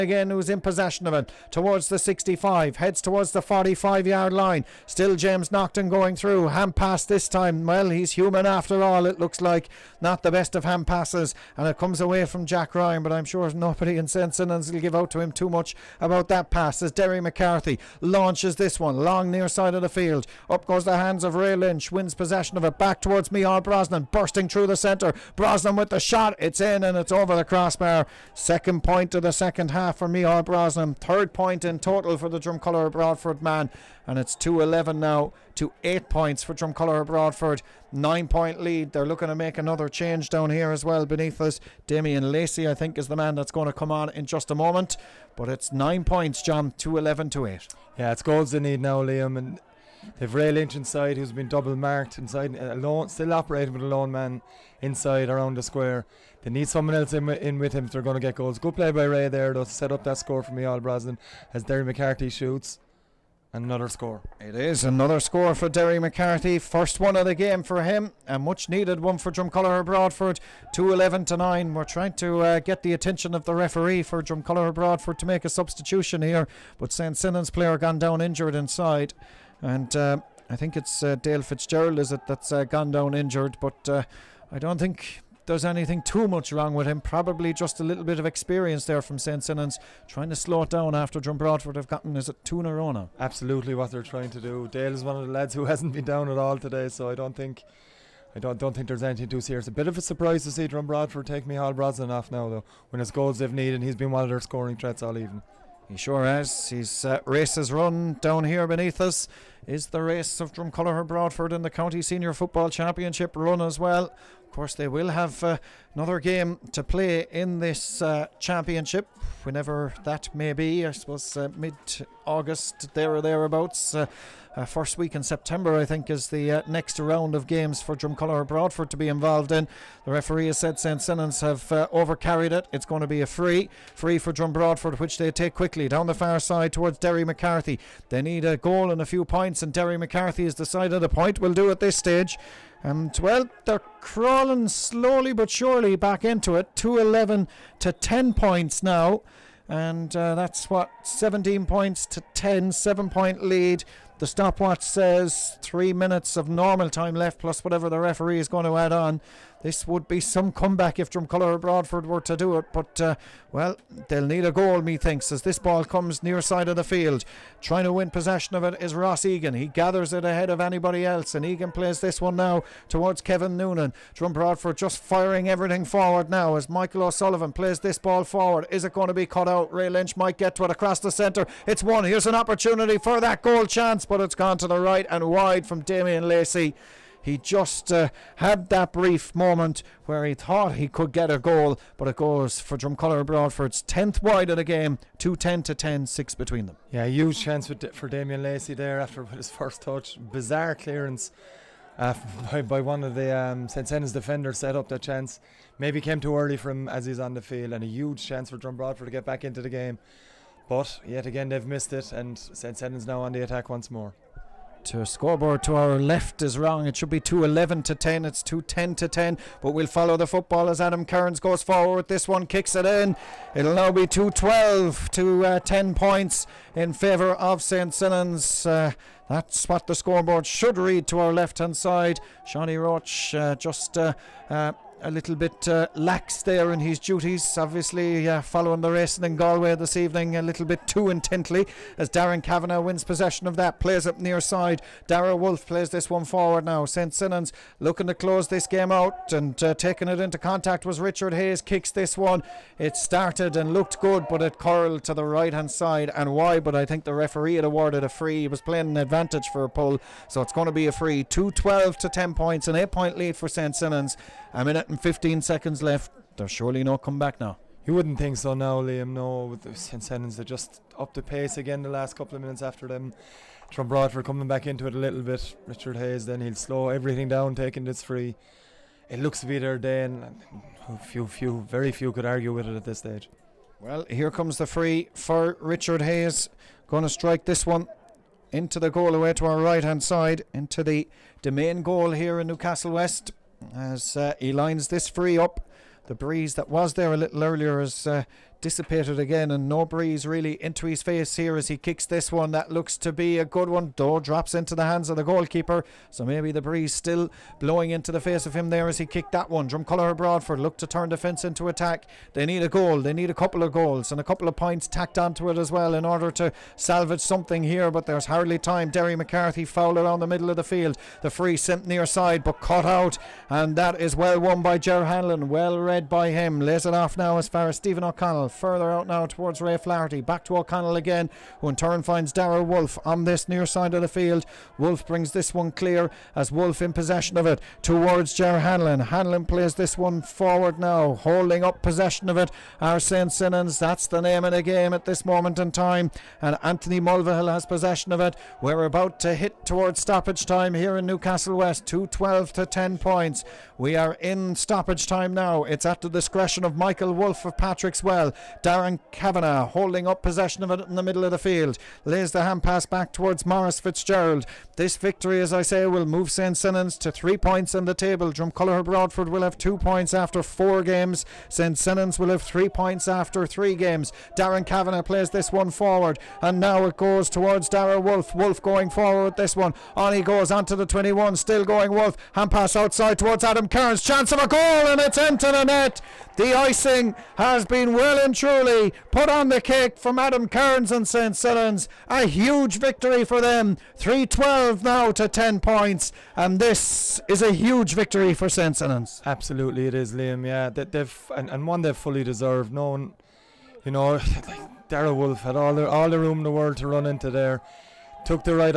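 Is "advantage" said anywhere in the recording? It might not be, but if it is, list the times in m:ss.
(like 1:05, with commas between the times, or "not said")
4:18.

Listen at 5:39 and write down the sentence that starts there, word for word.
Hanlon plays this one forward now, holding up possession of it.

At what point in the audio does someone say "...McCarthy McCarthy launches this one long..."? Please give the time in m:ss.
0:17.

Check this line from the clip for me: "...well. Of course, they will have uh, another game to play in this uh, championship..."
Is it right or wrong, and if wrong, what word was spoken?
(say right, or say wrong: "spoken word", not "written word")
right.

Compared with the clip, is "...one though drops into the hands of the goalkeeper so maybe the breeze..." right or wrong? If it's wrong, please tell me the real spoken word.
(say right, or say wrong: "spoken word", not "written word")
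right.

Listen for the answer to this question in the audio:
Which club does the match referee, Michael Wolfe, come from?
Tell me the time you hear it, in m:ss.
5:57.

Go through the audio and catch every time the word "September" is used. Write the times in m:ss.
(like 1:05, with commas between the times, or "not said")
2:05.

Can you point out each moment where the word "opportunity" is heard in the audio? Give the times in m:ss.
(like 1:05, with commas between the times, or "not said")
3:02.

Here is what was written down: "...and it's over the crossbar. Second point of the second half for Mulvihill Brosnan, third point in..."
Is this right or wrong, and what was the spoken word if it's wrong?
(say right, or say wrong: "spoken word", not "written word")
wrong: "Mihal", not "Mulvihill".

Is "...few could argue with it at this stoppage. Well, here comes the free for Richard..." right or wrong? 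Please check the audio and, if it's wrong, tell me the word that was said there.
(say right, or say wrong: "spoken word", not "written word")
wrong: "stage", not "stoppage".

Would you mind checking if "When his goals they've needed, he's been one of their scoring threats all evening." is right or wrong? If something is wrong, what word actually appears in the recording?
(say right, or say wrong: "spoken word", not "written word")
right.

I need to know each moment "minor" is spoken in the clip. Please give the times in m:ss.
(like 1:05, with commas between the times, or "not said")
not said.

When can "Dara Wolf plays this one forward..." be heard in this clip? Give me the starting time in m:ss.
4:05.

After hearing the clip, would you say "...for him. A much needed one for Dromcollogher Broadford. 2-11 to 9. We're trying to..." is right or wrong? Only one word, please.
right.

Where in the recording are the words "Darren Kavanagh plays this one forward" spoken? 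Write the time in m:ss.
6:14.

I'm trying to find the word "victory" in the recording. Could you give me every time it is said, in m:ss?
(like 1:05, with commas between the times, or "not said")
6:04, 6:32, 6:37.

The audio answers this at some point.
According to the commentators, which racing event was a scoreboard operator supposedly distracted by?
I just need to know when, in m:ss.
3:58.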